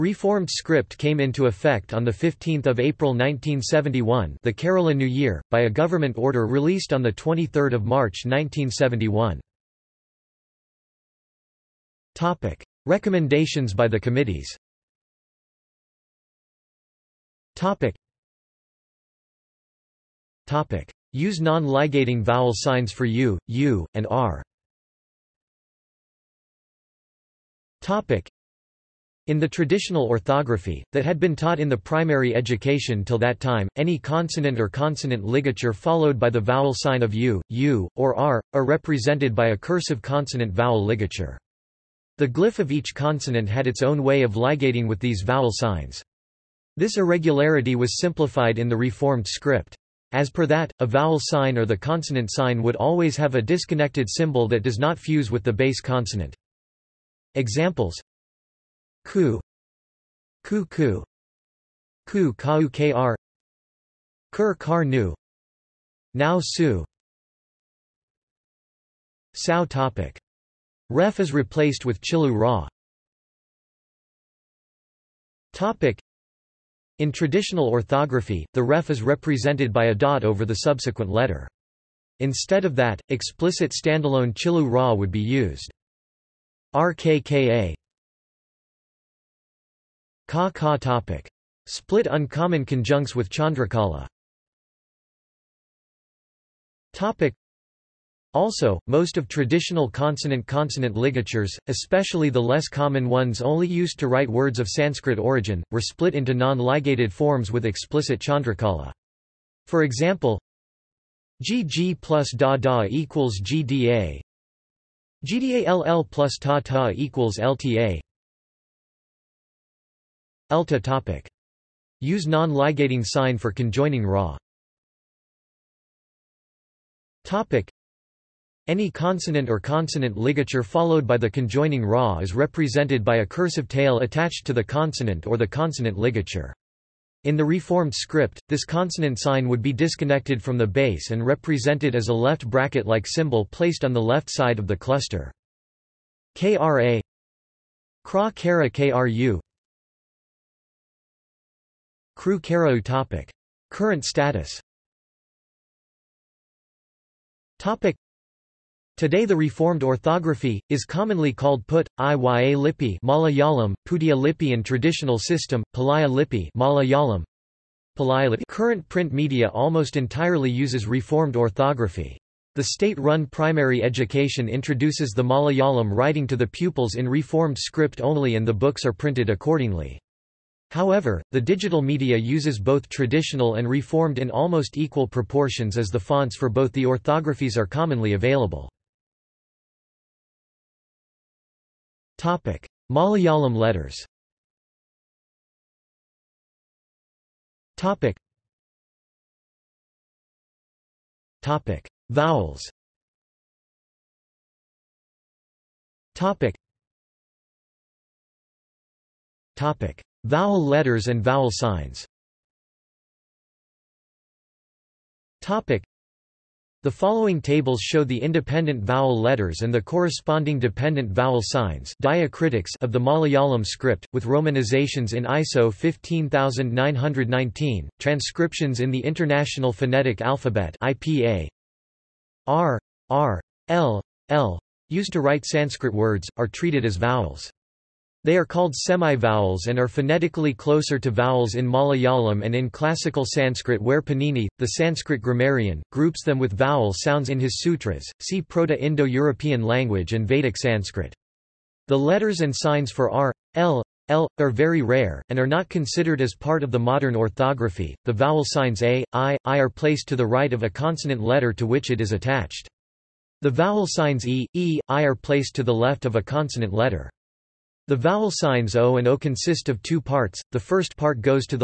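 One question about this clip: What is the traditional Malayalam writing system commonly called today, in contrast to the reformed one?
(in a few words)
Palaya Lippi.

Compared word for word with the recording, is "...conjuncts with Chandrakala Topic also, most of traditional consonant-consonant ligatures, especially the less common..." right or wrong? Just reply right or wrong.
right.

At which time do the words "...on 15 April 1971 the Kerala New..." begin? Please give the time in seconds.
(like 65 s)
1 s.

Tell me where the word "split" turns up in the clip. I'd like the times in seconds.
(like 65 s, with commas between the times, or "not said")
91 s, 105 s.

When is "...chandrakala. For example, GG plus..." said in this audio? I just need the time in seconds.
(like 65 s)
108 s.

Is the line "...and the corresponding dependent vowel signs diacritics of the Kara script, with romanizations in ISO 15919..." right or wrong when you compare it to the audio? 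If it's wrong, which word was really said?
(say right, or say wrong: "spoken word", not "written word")
wrong: "Malayalam", not "Kara".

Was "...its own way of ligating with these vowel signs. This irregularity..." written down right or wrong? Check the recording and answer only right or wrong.
right.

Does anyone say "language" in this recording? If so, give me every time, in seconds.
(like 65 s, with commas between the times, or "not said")
249 s.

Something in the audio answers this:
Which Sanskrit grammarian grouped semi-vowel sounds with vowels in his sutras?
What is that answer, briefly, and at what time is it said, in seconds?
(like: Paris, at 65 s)
Panini, at 244 s.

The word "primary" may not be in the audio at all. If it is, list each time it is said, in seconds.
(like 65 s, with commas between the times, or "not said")
31 s, 173 s.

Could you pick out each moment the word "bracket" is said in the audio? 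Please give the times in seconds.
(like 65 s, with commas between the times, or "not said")
142 s.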